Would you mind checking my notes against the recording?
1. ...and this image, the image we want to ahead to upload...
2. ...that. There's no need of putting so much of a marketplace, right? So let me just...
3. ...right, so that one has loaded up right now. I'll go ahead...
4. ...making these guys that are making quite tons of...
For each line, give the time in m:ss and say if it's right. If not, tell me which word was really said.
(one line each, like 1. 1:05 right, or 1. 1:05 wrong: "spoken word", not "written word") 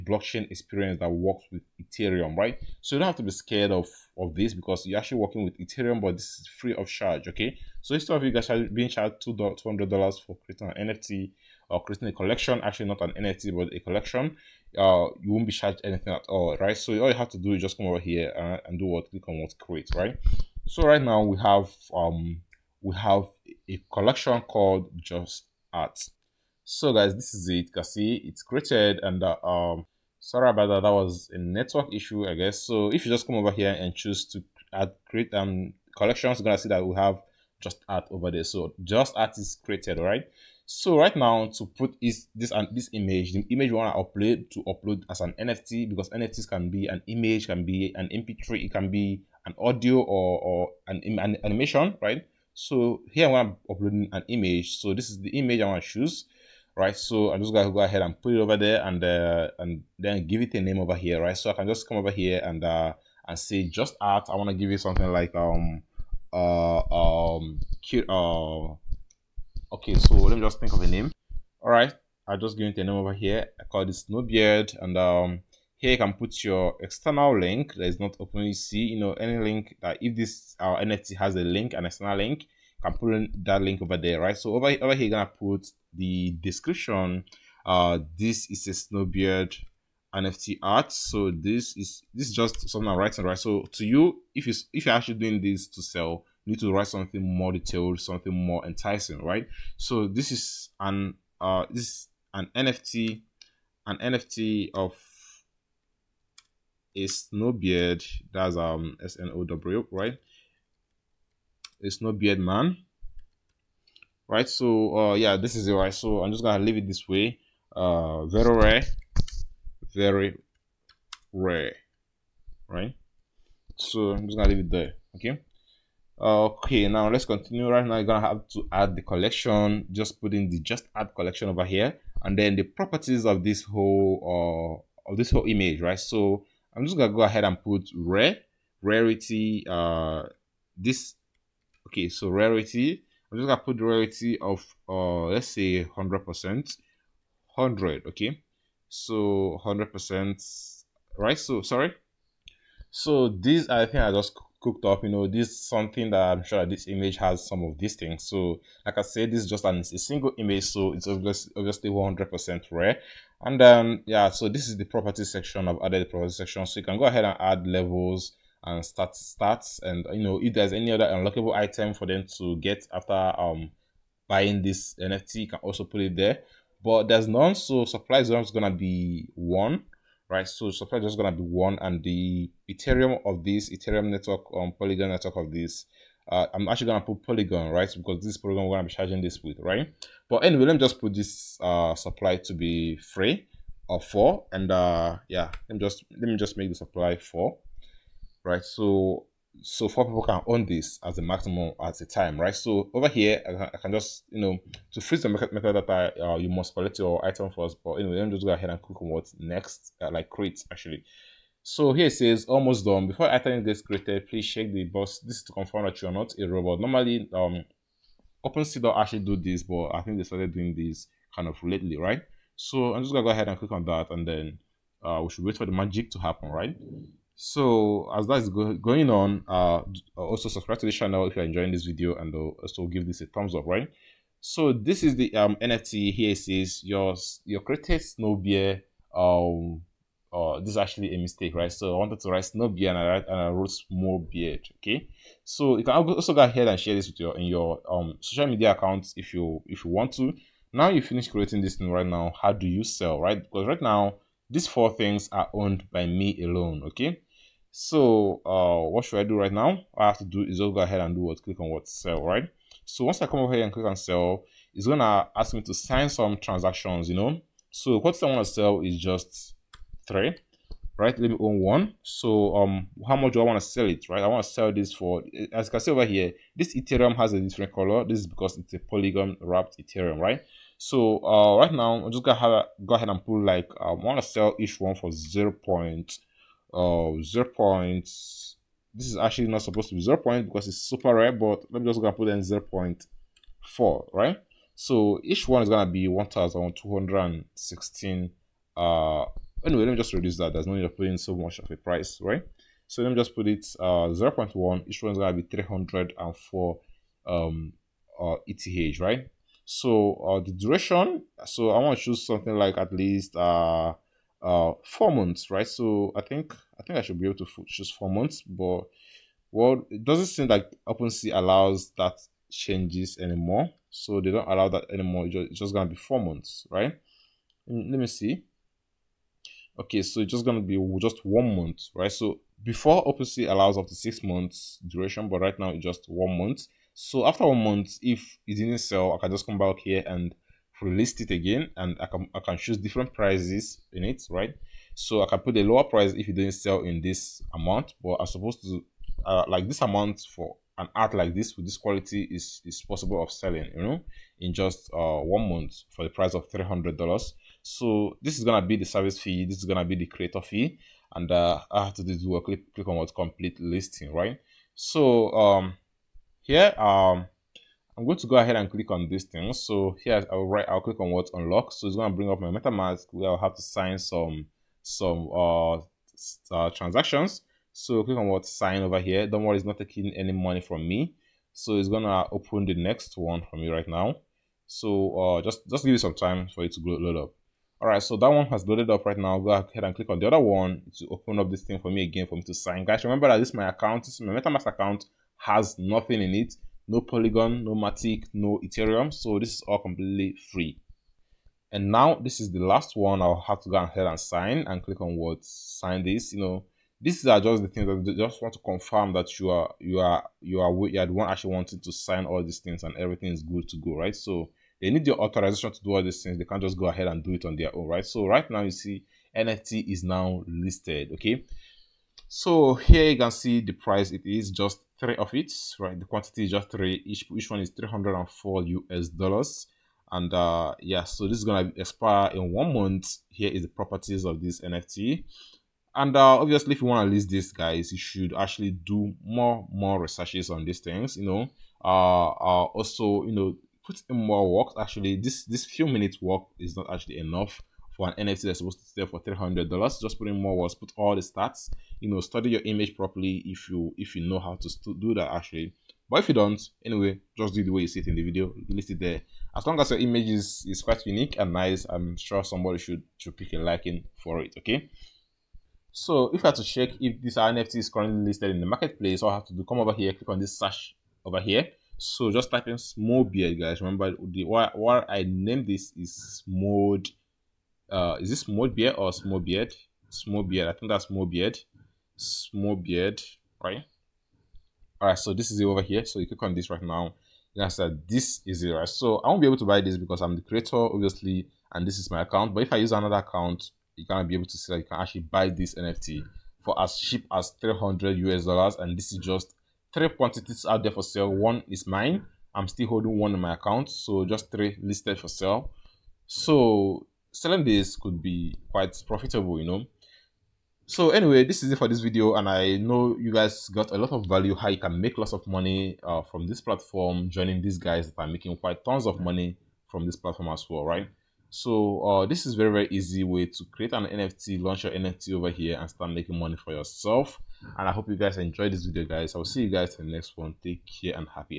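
1. 0:42 wrong: "upload", not "ahead"
2. 5:00 wrong: "price", not "marketplace"
3. 6:27 right
4. 8:37 wrong: "joining", not "making".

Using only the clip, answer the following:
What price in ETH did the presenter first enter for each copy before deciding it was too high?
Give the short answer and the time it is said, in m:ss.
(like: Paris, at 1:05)
0.4, at 4:52.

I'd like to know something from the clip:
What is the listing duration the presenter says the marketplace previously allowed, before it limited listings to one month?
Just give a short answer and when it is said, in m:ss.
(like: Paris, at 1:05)
6 months, at 5:33.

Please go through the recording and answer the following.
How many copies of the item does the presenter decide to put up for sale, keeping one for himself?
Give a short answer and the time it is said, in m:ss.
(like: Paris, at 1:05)
3, at 4:27.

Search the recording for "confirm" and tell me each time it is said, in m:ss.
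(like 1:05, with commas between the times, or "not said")
3:35, 6:48.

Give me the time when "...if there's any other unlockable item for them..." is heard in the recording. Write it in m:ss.
2:50.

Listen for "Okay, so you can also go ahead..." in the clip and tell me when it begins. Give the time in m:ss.
4:04.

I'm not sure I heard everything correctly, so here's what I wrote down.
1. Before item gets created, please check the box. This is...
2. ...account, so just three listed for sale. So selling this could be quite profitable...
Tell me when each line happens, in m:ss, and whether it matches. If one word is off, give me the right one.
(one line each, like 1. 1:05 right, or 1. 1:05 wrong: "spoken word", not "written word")
1. 3:33 right
2. 8:23 right.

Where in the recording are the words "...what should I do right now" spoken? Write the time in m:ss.
4:18.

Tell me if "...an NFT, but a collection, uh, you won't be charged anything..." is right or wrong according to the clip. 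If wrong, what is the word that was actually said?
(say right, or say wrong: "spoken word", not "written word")
right.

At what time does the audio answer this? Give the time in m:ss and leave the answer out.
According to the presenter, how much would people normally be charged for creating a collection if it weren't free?
0:09.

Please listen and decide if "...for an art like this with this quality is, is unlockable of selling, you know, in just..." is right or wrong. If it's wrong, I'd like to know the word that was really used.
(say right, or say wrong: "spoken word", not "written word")
wrong: "possible", not "unlockable".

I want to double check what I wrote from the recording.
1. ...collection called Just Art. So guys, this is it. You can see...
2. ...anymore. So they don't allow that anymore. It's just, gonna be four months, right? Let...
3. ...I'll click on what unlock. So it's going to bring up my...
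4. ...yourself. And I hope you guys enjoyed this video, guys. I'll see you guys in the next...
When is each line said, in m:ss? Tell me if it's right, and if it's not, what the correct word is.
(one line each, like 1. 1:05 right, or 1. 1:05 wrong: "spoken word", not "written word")
1. 0:23 right
2. 5:23 right
3. 6:10 right
4. 8:46 right.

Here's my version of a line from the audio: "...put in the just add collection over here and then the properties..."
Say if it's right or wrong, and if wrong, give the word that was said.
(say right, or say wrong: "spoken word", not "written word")
right.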